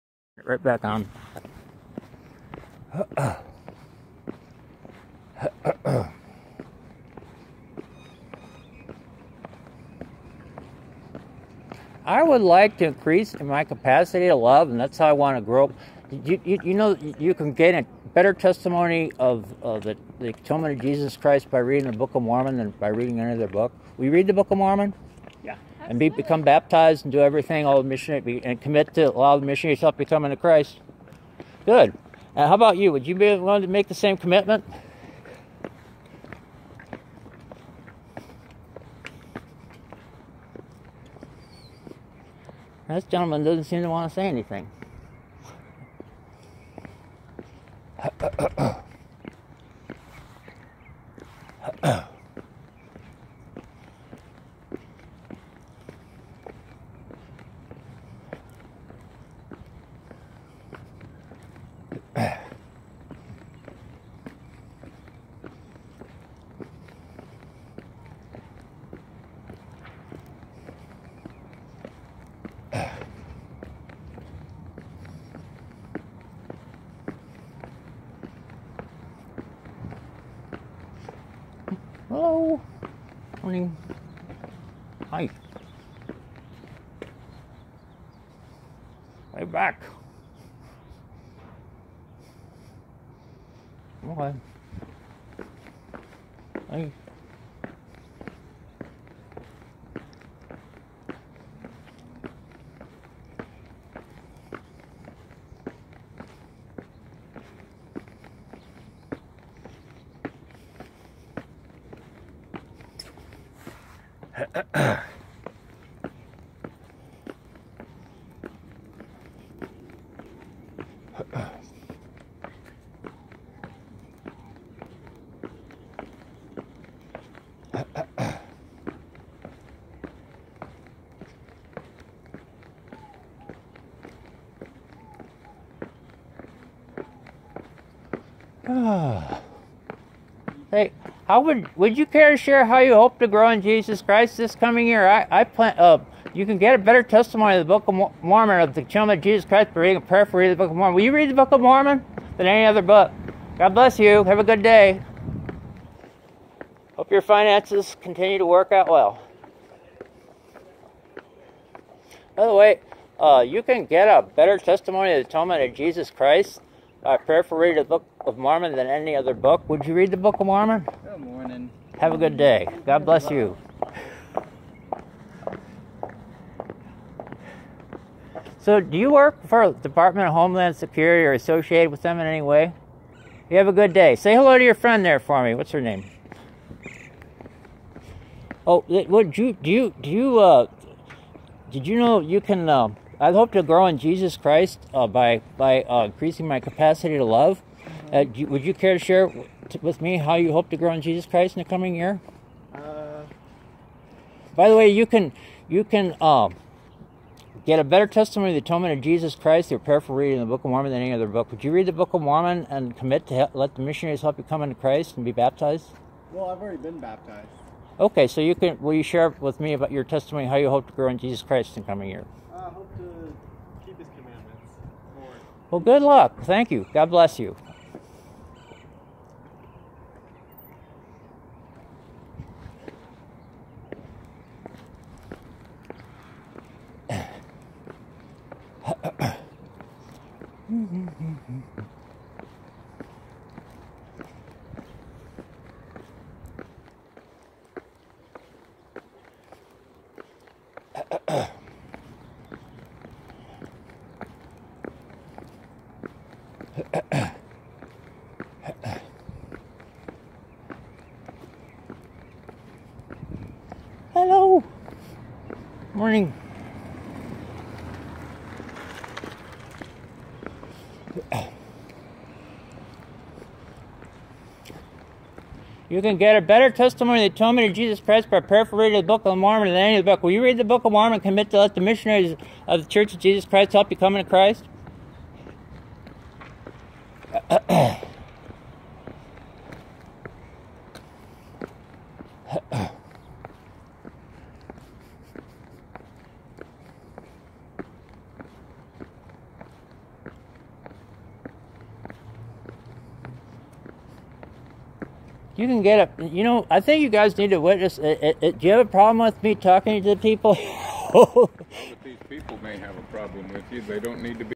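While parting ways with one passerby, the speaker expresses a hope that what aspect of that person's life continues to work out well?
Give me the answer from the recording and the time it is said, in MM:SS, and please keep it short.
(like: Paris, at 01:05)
finances, at 02:37.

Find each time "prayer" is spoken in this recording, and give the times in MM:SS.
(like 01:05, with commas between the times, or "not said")
02:30, 02:47, 03:29.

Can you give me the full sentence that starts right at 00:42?
This gentleman doesn't seem to want to say anything.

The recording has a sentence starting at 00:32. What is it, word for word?
Would you be willing to make the same commitment?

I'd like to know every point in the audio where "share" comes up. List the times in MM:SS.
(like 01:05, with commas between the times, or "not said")
02:22, 03:18, 03:39.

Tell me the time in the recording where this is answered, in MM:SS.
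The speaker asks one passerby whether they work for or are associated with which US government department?
02:59.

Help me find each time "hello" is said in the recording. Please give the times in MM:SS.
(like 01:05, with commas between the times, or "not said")
01:22, 03:04, 04:24.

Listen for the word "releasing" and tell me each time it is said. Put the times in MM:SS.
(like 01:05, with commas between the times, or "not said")
not said.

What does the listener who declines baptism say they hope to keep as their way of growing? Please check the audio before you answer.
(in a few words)
his commandments.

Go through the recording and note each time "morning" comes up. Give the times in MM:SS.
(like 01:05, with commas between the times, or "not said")
01:23, 02:51, 04:25.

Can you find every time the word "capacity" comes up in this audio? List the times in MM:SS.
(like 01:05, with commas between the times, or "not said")
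00:13, 03:16.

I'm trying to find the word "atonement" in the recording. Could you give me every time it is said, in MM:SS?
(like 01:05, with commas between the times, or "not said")
00:20, 02:45, 03:28, 04:37.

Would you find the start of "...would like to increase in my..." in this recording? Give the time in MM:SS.
00:12.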